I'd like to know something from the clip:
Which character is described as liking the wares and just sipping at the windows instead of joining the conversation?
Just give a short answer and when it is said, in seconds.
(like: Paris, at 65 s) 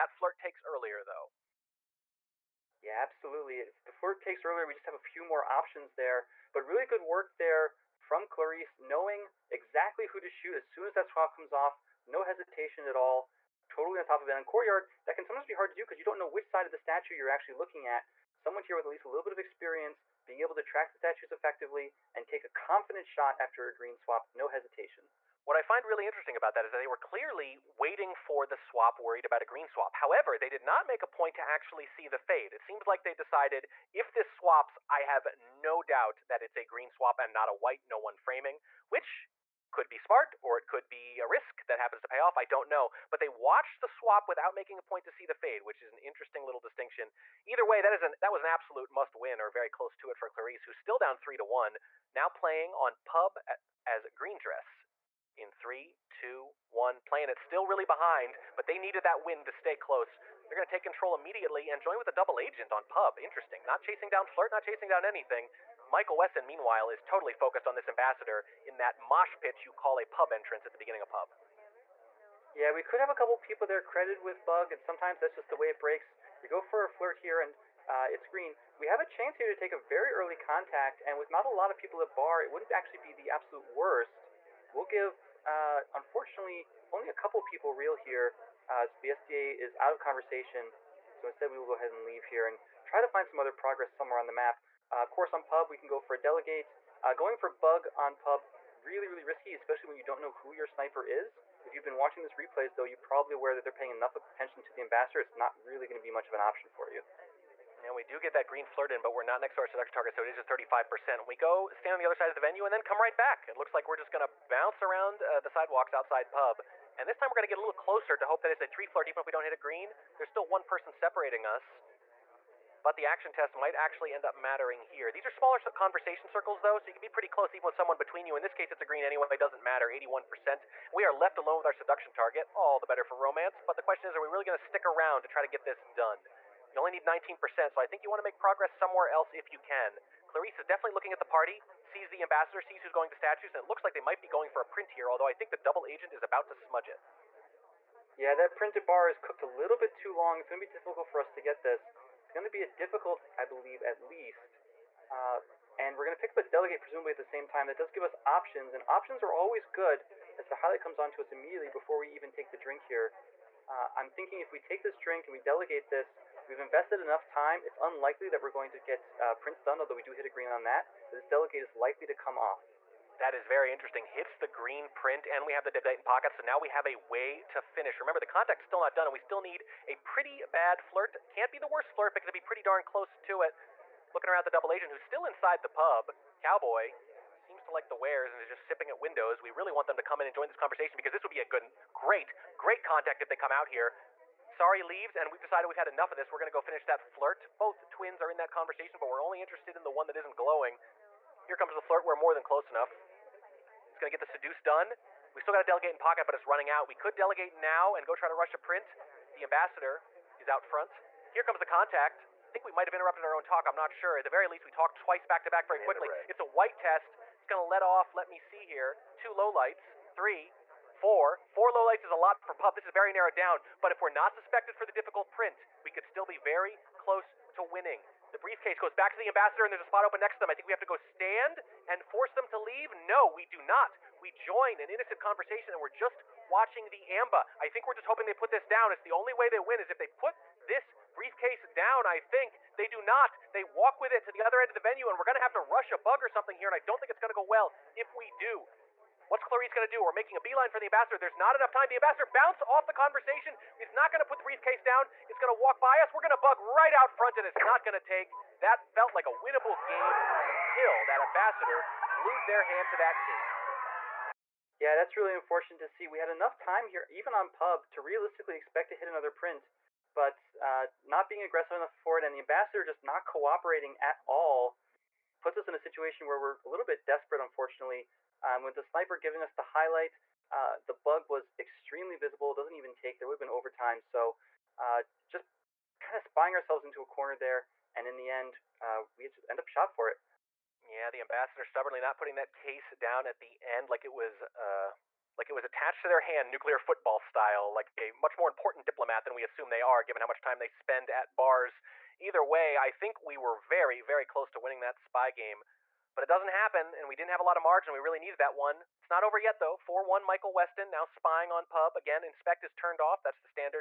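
Cowboy, at 186 s.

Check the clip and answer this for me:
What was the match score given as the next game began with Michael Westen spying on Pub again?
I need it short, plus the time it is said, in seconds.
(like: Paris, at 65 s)
4-1, at 309 s.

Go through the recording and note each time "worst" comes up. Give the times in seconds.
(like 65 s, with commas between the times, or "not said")
83 s, 181 s.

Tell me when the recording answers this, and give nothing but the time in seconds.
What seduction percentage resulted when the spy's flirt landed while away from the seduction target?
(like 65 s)
110 s.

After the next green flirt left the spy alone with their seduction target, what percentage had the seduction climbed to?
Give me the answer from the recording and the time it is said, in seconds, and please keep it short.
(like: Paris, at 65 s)
81%, at 129 s.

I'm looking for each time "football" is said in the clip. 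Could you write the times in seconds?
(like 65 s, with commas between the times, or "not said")
296 s.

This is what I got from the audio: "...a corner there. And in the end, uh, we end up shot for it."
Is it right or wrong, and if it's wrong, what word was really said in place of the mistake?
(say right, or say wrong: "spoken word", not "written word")
right.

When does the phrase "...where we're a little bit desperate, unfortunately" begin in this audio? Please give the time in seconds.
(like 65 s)
276 s.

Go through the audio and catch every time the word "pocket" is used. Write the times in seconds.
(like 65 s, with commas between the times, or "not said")
176 s, 205 s.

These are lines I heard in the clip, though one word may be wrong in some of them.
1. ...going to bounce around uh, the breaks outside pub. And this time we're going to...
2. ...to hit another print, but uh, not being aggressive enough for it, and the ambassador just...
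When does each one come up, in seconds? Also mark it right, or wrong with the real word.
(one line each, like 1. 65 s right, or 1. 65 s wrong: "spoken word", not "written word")
1. 114 s wrong: "sidewalks", not "breaks"
2. 268 s right.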